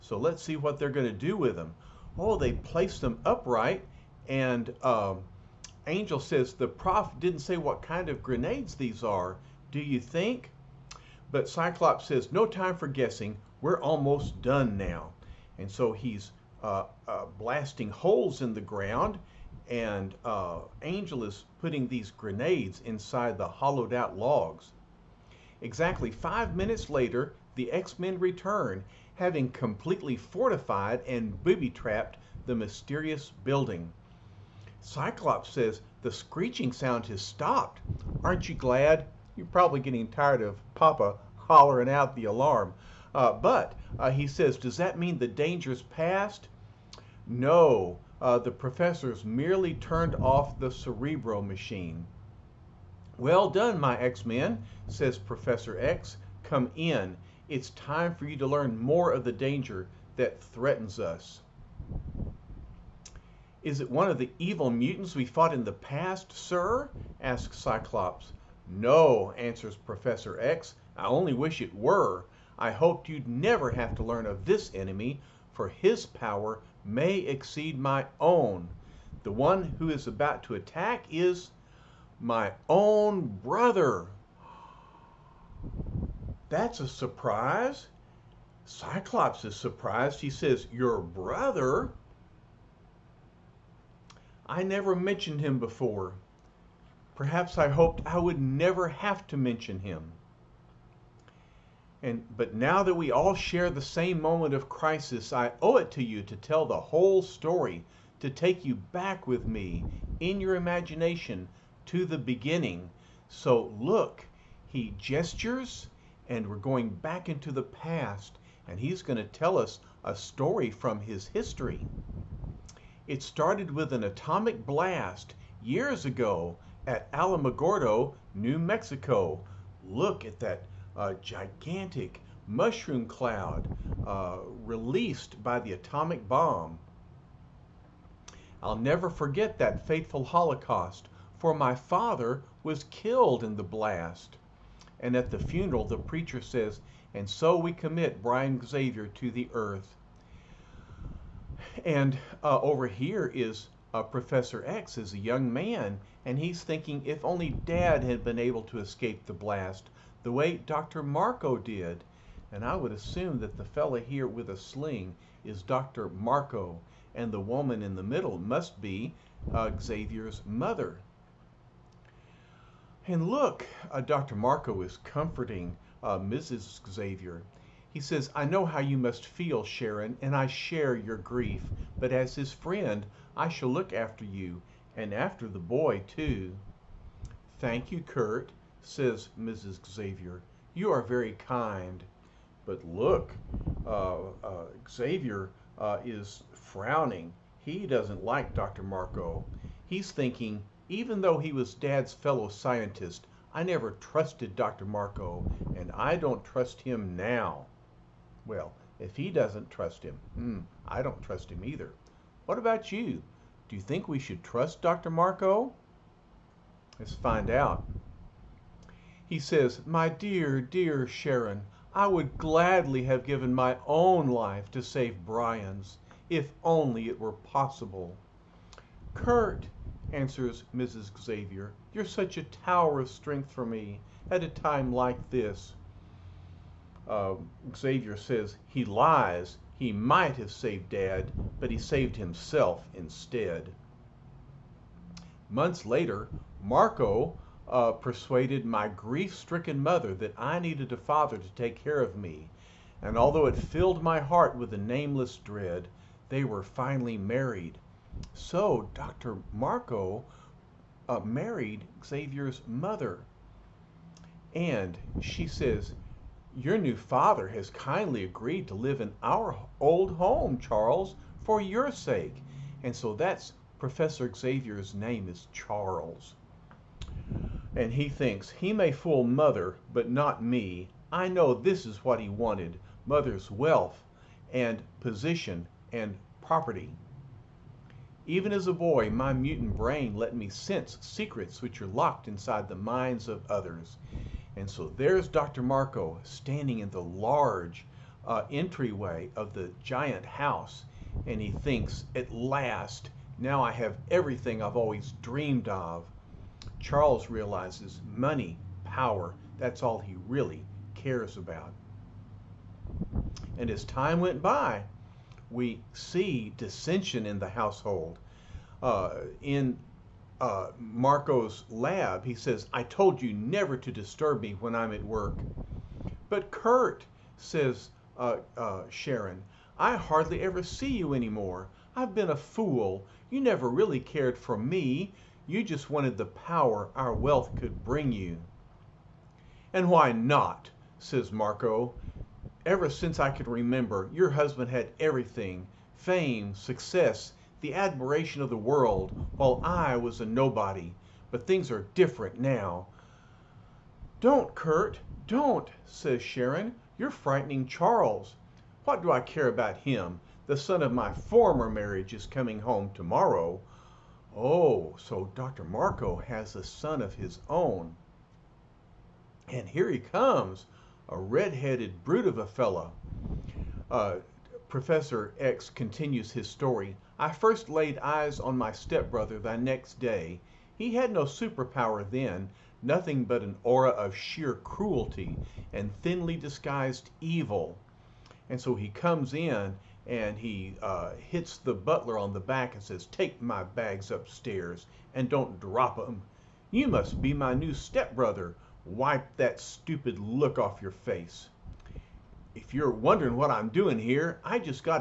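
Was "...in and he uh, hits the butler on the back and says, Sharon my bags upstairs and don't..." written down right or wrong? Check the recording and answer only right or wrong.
wrong.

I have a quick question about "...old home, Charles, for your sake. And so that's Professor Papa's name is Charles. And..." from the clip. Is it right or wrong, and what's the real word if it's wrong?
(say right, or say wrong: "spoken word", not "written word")
wrong: "Xavier", not "Papa".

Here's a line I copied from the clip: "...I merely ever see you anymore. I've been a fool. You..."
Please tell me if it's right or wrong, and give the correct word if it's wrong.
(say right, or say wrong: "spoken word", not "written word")
wrong: "hardly", not "merely".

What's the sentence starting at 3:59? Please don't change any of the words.
He might have saved Dad, but he saved himself instead.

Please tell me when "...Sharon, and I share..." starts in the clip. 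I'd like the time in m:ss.
2:59.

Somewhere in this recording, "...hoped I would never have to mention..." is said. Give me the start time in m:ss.
1:37.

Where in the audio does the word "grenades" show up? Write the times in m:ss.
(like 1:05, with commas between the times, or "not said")
0:08, 0:22.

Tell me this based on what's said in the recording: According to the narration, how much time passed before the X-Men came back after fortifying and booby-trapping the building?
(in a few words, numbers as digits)
5 minutes.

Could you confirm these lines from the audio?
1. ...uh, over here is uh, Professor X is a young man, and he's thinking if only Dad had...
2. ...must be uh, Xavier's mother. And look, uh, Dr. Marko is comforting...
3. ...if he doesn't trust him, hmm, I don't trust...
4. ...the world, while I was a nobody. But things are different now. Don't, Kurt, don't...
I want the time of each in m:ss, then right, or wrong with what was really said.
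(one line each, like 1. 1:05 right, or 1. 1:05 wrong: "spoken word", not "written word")
1. 2:32 right
2. 2:48 right
3. 3:28 right
4. 5:48 right.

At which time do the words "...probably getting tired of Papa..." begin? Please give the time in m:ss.
0:39.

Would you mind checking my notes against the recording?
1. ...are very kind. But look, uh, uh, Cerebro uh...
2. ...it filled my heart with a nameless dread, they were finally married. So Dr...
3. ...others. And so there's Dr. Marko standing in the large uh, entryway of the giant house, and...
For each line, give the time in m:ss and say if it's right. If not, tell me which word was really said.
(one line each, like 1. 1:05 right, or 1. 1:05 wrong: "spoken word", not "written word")
1. 3:10 wrong: "Xavier", not "Cerebro"
2. 4:13 right
3. 4:53 right.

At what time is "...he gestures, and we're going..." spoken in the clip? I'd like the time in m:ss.
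1:54.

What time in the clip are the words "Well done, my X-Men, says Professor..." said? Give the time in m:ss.
0:53.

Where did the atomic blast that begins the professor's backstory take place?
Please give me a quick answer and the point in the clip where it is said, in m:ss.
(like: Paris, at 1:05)
Alamogordo, New Mexico, at 2:07.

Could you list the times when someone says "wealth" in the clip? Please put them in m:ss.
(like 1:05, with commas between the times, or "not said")
4:43, 5:37.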